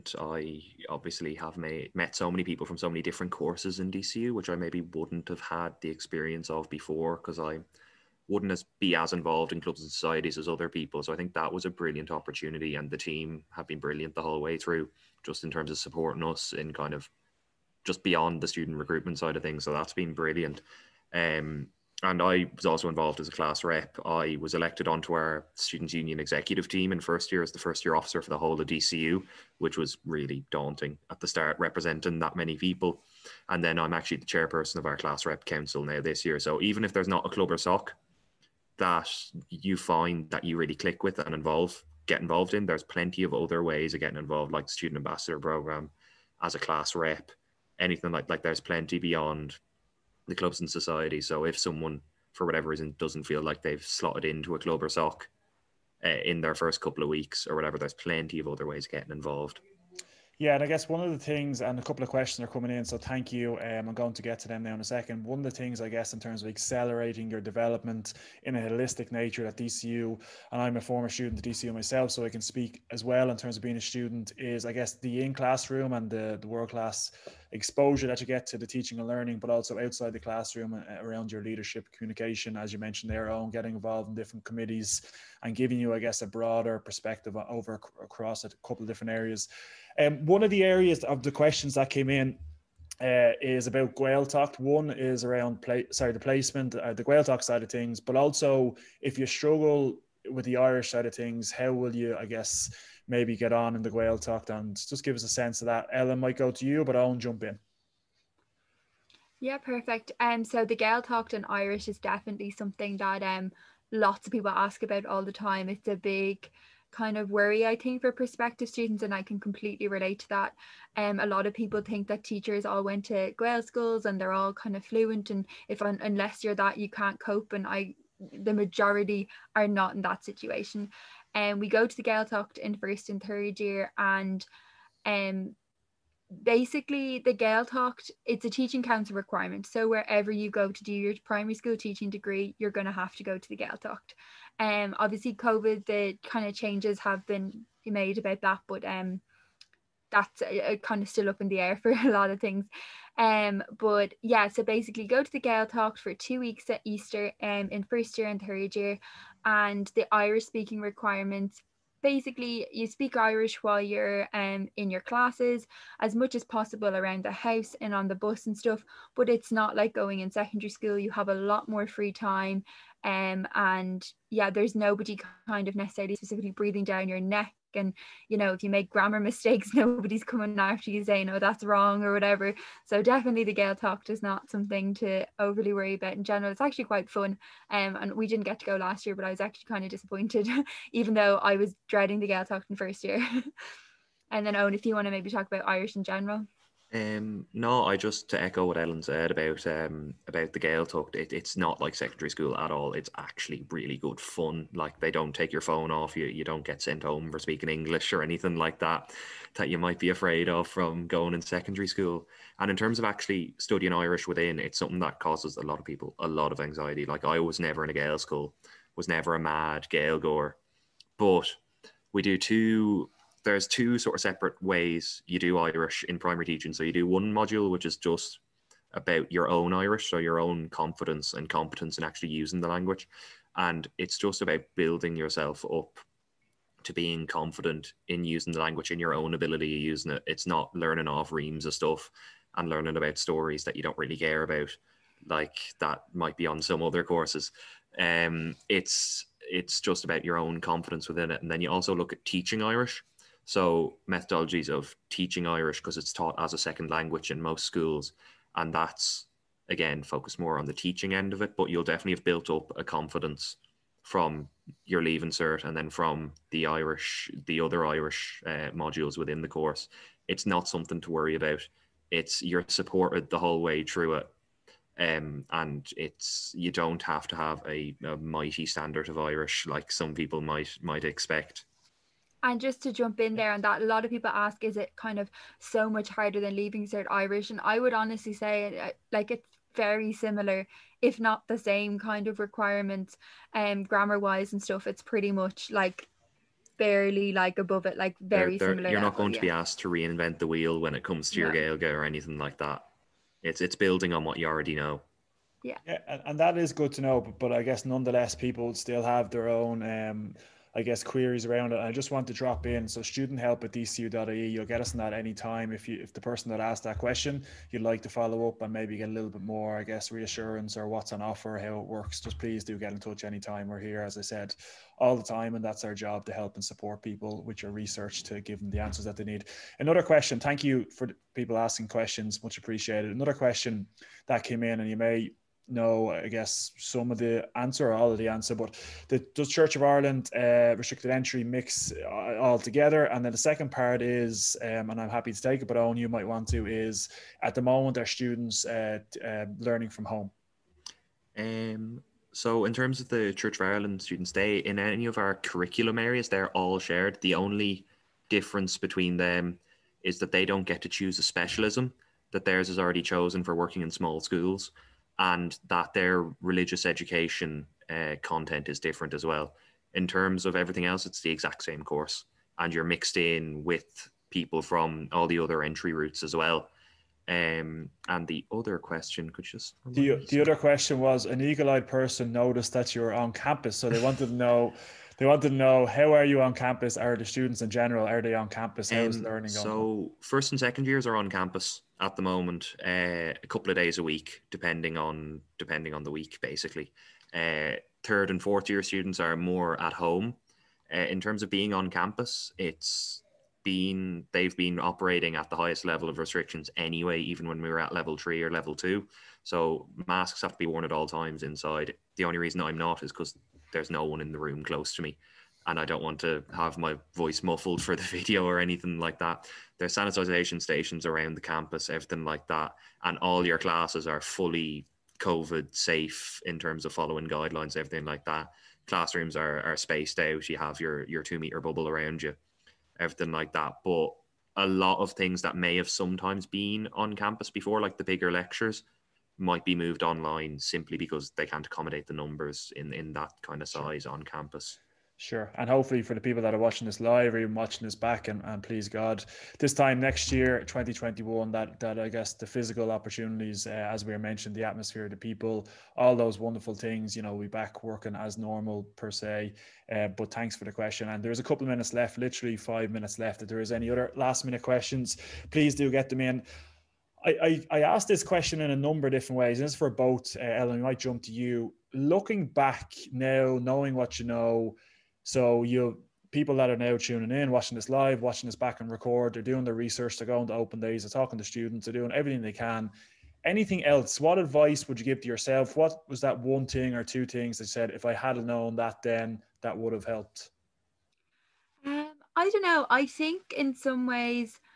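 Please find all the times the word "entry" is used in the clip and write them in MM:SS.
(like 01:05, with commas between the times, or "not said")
05:41, 06:15.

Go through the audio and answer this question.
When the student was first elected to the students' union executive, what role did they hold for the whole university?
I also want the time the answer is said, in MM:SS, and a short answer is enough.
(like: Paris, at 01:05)
First year officer, at 00:27.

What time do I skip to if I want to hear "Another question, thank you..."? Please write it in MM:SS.
05:29.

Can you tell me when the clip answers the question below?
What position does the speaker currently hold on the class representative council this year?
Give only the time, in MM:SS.
00:34.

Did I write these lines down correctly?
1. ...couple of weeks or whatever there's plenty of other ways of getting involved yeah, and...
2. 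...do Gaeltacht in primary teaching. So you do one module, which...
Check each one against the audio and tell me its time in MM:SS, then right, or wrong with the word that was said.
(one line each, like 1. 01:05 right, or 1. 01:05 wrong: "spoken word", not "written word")
1. 00:56 right
2. 03:45 wrong: "Irish", not "Gaeltacht".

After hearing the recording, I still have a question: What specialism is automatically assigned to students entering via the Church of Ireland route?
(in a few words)
Working in small schools.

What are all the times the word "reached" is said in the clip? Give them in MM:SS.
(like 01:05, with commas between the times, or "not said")
not said.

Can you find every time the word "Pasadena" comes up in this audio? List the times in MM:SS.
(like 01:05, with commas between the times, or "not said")
not said.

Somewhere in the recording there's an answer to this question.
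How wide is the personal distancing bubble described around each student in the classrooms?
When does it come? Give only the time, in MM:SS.
07:11.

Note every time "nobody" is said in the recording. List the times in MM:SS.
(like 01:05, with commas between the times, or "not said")
02:54, 02:59.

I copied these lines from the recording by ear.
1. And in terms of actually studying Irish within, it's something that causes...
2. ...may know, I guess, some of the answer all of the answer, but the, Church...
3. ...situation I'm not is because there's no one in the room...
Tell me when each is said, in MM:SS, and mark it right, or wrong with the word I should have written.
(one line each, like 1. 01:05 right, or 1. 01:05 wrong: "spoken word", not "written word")
1. 03:32 right
2. 05:34 right
3. 06:52 wrong: "reason", not "situation".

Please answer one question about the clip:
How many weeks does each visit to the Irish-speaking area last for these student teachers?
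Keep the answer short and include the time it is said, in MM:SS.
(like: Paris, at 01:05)
2, at 02:36.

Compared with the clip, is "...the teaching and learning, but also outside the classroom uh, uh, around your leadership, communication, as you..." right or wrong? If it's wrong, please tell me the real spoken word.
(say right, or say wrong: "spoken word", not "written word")
right.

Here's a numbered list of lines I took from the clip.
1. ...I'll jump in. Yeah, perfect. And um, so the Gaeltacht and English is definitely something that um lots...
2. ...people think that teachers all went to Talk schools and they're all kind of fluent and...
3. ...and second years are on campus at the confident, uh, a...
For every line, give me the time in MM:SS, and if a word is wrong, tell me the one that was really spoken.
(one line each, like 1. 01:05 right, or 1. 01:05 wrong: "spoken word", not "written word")
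1. 01:46 wrong: "Irish", not "English"
2. 02:01 wrong: "Gaelic", not "Talk"
3. 06:30 wrong: "moment", not "confident".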